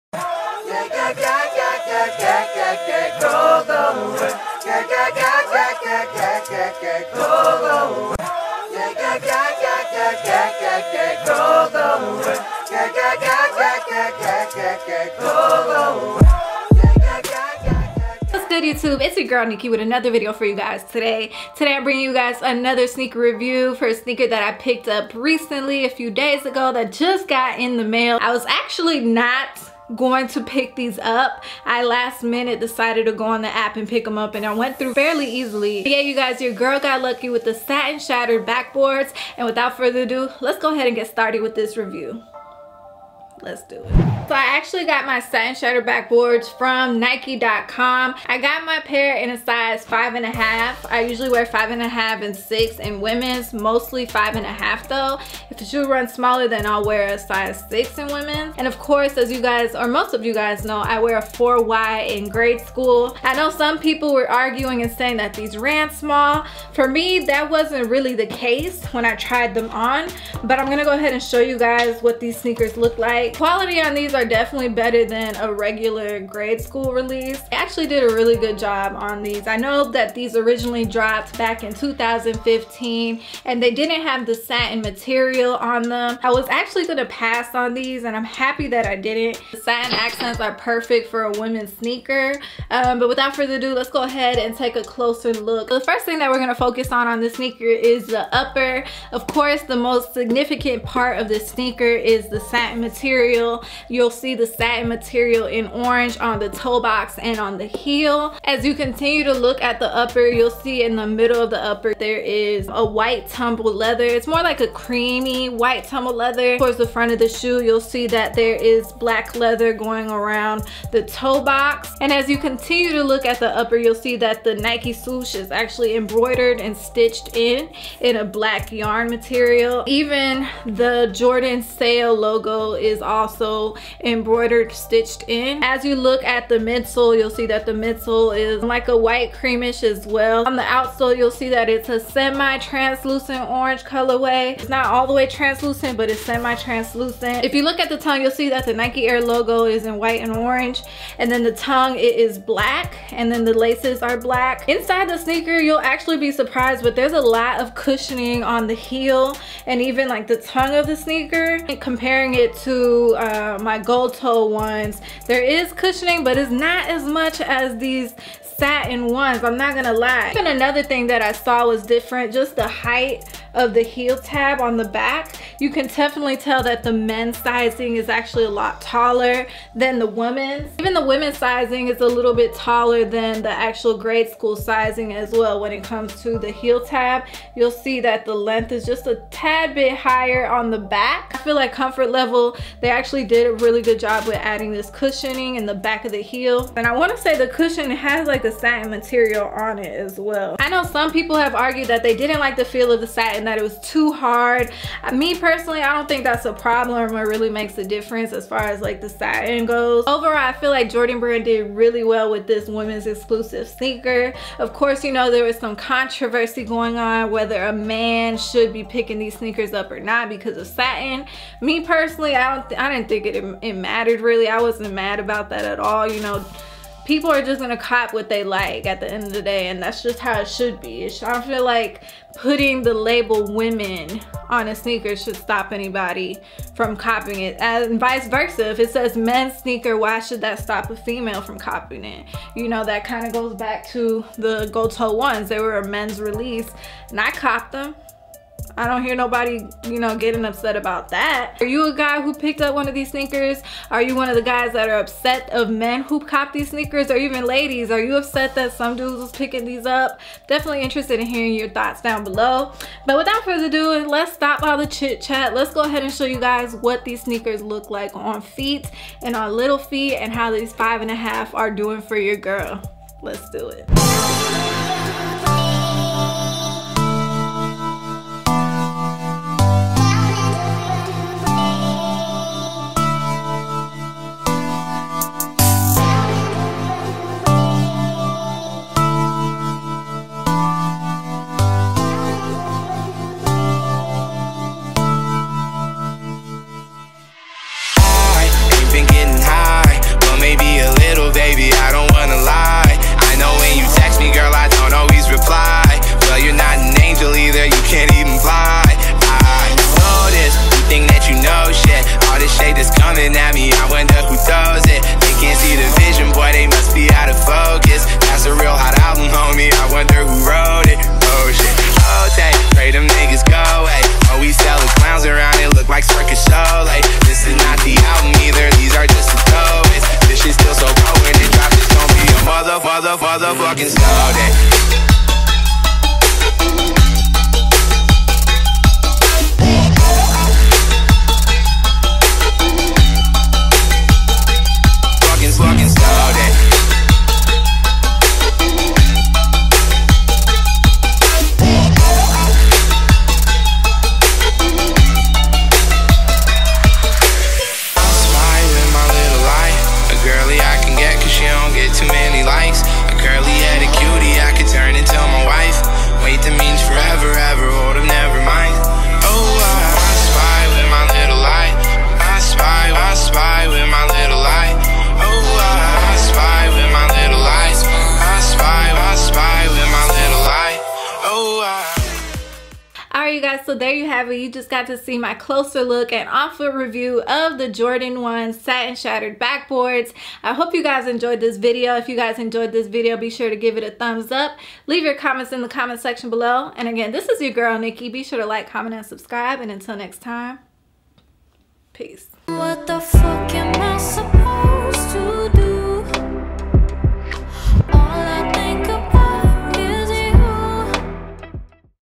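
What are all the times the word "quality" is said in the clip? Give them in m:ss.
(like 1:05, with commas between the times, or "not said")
1:13.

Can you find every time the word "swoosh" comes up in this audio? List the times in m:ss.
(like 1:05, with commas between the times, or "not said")
2:04.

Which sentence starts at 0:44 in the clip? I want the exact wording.
So I actually got my satin shattered backboards from Nike.com.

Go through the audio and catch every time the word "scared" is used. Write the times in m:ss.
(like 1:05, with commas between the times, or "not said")
not said.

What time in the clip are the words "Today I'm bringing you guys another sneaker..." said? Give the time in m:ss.
0:21.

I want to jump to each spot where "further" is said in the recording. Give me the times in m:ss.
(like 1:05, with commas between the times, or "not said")
0:39, 1:33, 4:23.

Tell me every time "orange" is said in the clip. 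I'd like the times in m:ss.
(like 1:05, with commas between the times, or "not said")
1:45, 2:23, 2:30.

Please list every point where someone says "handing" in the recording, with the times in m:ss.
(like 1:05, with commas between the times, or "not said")
not said.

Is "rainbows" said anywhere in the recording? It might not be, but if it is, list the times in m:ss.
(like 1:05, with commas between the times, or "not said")
not said.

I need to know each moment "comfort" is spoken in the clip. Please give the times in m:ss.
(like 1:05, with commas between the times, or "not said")
3:11.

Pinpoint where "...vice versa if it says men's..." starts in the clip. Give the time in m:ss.
3:57.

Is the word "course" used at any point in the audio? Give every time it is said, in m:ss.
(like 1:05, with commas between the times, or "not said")
0:58, 1:39, 3:34.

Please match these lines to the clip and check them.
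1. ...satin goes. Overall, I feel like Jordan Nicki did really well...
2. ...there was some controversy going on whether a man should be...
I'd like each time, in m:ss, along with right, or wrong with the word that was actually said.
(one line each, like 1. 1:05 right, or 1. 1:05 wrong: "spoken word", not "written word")
1. 3:29 wrong: "Brand", not "Nicki"
2. 3:35 right.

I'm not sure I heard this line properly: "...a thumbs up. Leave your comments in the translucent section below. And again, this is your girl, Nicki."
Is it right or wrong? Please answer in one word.
wrong.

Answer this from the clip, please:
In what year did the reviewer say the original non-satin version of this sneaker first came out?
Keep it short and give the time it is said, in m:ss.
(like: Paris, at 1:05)
2015, at 1:21.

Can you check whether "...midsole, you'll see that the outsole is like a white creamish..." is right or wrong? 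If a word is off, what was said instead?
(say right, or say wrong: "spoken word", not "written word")
wrong: "midsole", not "outsole".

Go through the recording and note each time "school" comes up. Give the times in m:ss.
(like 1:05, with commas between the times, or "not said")
1:02, 1:16, 3:04.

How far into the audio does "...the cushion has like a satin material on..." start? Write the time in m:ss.
3:17.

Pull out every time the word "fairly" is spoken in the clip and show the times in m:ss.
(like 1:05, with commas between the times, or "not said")
0:34.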